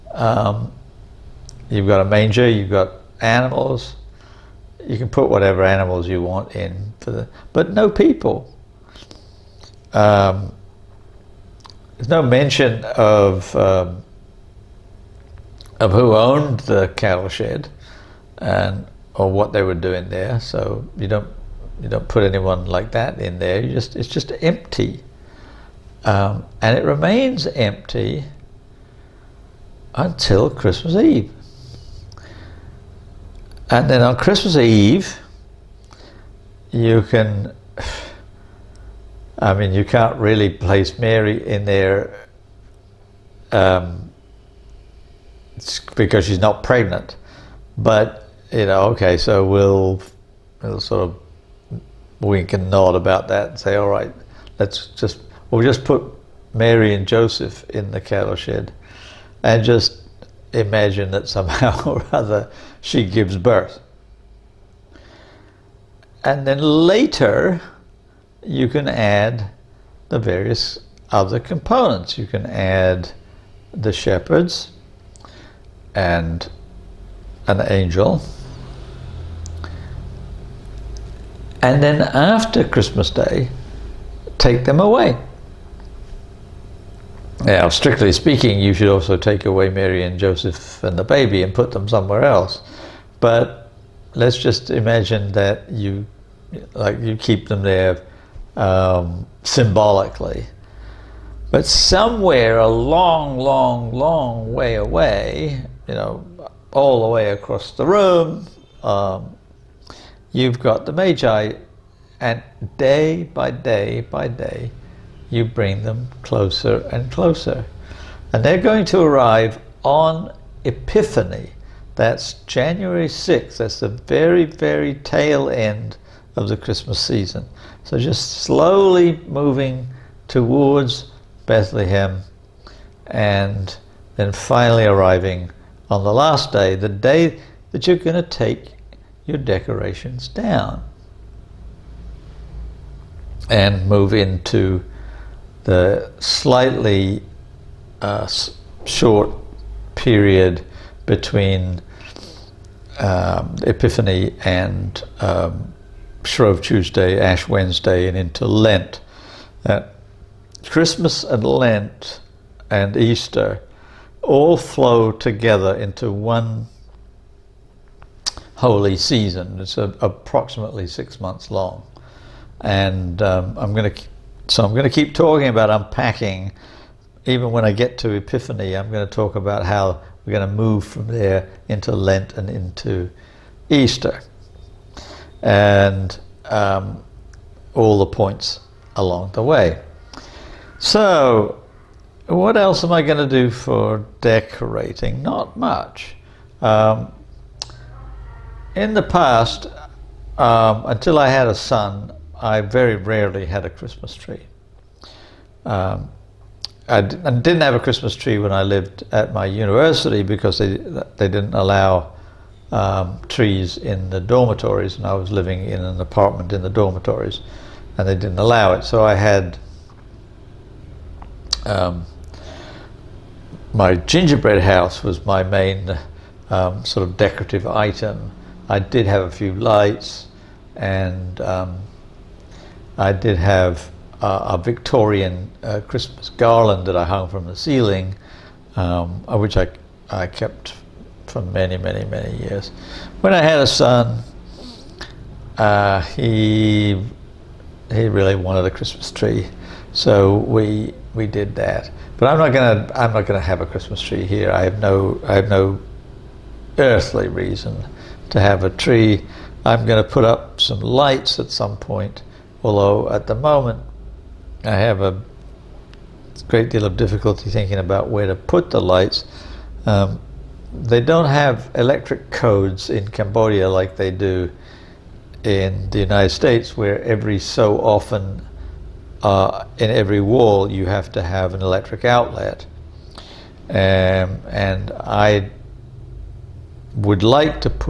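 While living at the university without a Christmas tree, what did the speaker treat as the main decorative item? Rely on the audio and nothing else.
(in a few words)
gingerbread house.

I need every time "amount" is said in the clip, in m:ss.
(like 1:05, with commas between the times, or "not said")
not said.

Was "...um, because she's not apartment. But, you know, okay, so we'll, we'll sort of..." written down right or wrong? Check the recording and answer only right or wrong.
wrong.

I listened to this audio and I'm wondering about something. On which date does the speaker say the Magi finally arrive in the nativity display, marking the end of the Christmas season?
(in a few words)
January 6th.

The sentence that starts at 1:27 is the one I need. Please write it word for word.
Now, strictly speaking, you should also take away Mary and Joseph and the baby and put them somewhere else.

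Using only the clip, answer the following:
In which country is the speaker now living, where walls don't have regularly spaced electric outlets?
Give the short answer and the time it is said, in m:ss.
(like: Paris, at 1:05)
Cambodia, at 4:33.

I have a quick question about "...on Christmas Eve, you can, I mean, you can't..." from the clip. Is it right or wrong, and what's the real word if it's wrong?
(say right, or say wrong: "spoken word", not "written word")
right.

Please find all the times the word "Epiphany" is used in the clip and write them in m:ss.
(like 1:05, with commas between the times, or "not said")
2:00, 2:33, 2:58.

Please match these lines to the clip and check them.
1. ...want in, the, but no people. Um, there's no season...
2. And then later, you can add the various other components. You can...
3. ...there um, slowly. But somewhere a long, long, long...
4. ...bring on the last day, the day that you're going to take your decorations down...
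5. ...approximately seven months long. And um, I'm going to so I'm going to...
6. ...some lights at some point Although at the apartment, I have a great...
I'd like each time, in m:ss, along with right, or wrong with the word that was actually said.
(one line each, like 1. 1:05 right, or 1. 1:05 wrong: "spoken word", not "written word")
1. 0:06 wrong: "mention", not "season"
2. 1:06 right
3. 1:37 wrong: "symbolically", not "slowly"
4. 2:14 wrong: "arriving", not "bring"
5. 2:50 wrong: "six", not "seven"
6. 4:20 wrong: "moment", not "apartment".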